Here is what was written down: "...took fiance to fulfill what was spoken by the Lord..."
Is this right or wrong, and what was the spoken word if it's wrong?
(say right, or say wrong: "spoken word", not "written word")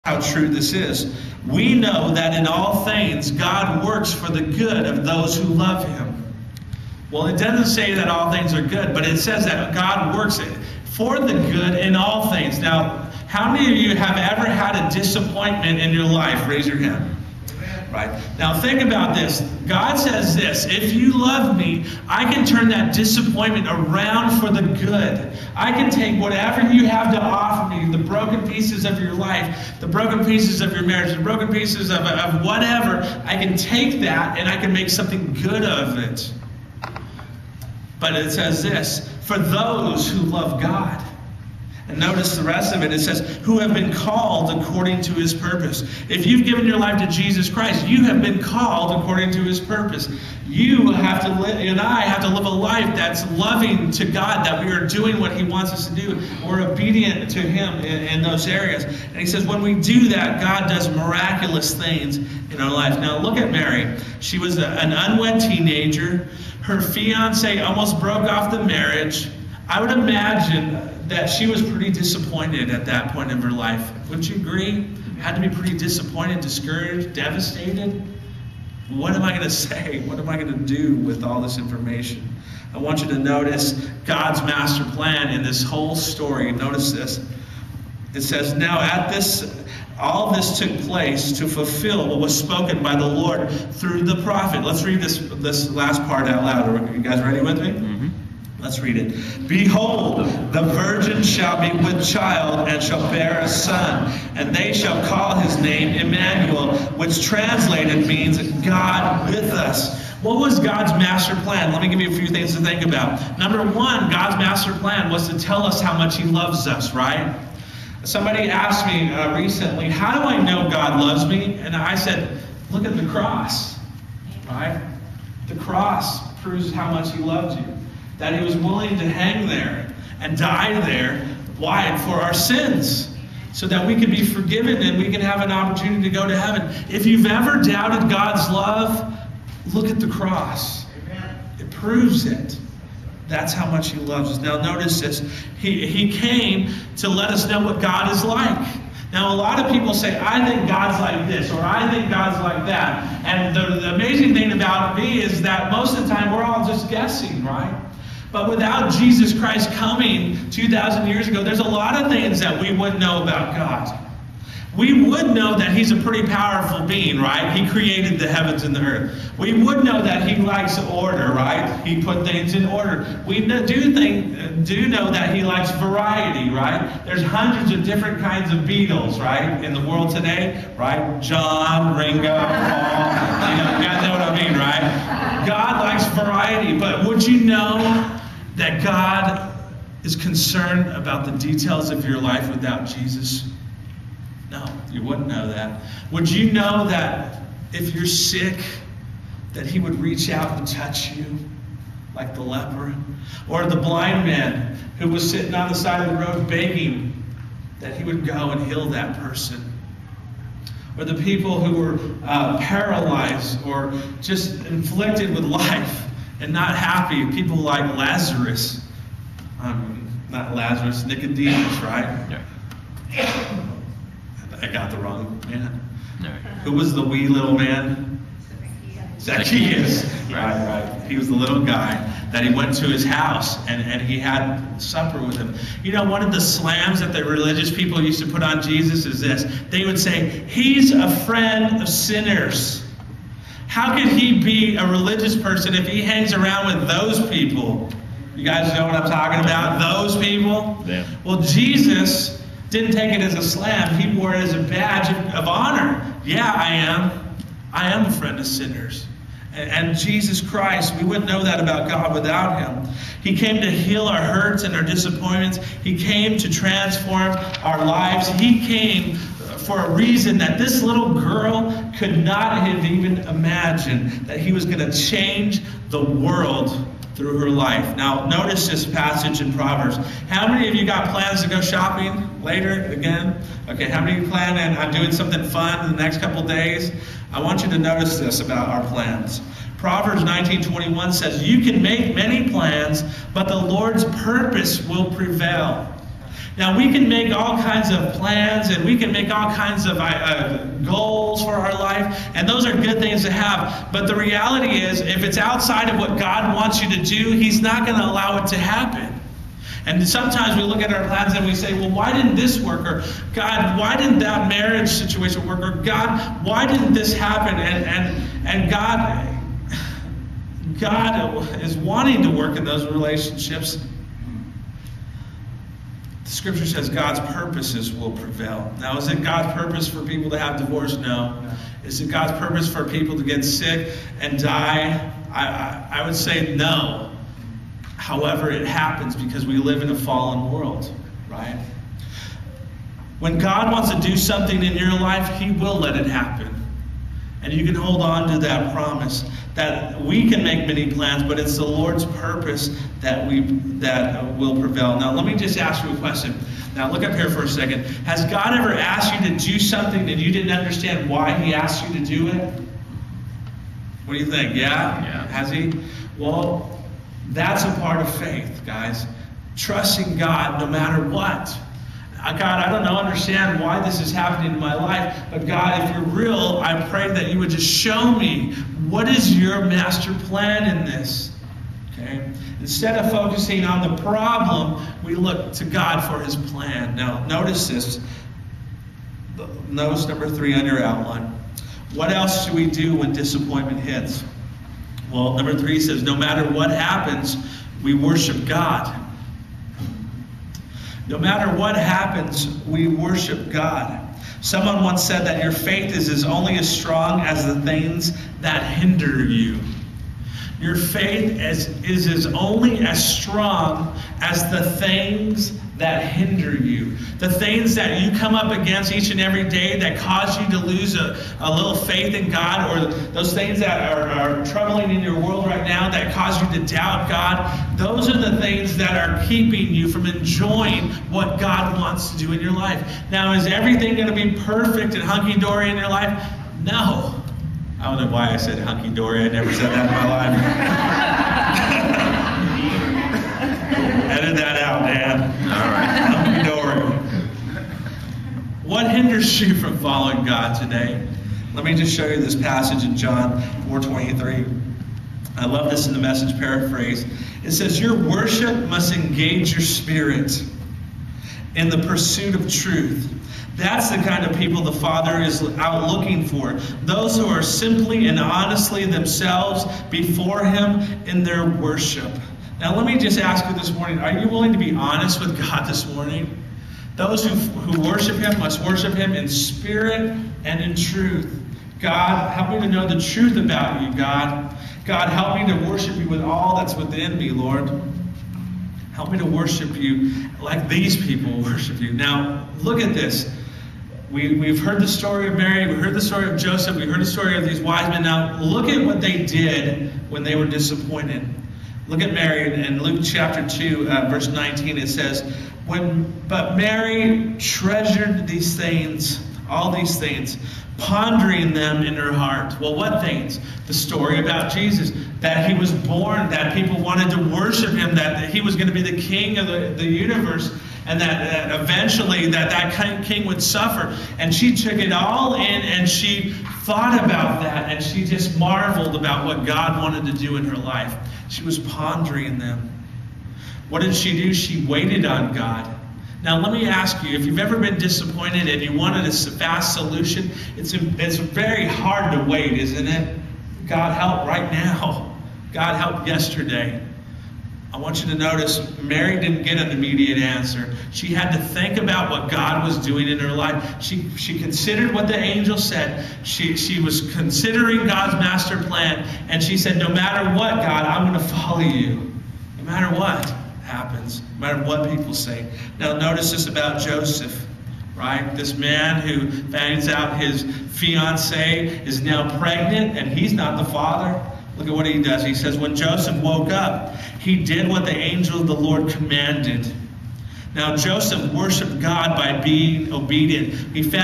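wrong: "place", not "fiance".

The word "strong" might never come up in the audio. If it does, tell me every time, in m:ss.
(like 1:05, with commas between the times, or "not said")
6:46, 6:53.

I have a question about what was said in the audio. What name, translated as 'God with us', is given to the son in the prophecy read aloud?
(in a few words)
Emmanuel.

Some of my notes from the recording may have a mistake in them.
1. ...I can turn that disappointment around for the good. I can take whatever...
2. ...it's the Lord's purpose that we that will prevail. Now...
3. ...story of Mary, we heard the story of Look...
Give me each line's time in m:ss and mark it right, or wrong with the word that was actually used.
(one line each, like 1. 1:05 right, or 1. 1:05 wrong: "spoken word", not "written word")
1. 0:22 right
2. 5:51 right
3. 8:14 wrong: "Joseph", not "Look".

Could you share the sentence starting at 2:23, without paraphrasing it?
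That's how much he loves us.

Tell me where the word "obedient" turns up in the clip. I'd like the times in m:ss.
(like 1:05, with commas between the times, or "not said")
0:56, 9:42.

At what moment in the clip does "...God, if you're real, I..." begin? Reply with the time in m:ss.
6:15.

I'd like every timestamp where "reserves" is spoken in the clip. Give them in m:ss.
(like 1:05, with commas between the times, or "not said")
not said.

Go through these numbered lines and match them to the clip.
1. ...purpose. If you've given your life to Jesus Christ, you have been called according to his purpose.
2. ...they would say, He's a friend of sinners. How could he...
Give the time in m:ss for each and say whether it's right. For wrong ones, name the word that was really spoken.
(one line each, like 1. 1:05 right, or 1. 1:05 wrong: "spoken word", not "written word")
1. 0:45 right
2. 3:59 right.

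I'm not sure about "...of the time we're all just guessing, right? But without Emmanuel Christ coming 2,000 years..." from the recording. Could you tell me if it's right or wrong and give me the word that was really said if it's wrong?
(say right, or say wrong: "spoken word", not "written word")
wrong: "Jesus", not "Emmanuel".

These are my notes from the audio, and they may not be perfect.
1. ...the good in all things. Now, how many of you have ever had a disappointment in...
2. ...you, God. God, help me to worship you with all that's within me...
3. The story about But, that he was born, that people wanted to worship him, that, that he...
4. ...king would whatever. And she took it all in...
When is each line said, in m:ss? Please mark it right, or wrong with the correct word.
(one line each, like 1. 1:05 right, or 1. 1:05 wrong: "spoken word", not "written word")
1. 0:11 right
2. 8:03 right
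3. 8:33 wrong: "Jesus", not "But"
4. 8:43 wrong: "suffer", not "whatever".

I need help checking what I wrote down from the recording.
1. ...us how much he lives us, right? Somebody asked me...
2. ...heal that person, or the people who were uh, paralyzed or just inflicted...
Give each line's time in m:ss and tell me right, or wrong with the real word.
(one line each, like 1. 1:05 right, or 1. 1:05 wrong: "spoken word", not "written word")
1. 1:55 wrong: "loves", not "lives"
2. 3:28 right.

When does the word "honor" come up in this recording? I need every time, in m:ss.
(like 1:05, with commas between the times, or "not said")
4:15.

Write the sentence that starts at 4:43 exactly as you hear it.
Okay, how many of you plan on doing something fun in the next couple days?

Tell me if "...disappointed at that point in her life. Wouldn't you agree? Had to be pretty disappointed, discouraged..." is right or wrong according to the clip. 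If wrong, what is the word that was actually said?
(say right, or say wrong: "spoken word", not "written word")
right.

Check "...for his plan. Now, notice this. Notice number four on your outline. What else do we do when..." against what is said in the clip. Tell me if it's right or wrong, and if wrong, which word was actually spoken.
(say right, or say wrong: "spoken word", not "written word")
wrong: "three", not "four".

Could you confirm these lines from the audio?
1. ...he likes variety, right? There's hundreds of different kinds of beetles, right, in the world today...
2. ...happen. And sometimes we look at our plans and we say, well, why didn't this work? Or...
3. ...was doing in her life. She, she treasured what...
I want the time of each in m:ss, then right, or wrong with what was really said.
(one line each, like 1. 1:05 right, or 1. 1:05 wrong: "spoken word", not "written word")
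1. 2:55 right
2. 5:08 right
3. 9:12 wrong: "considered", not "treasured".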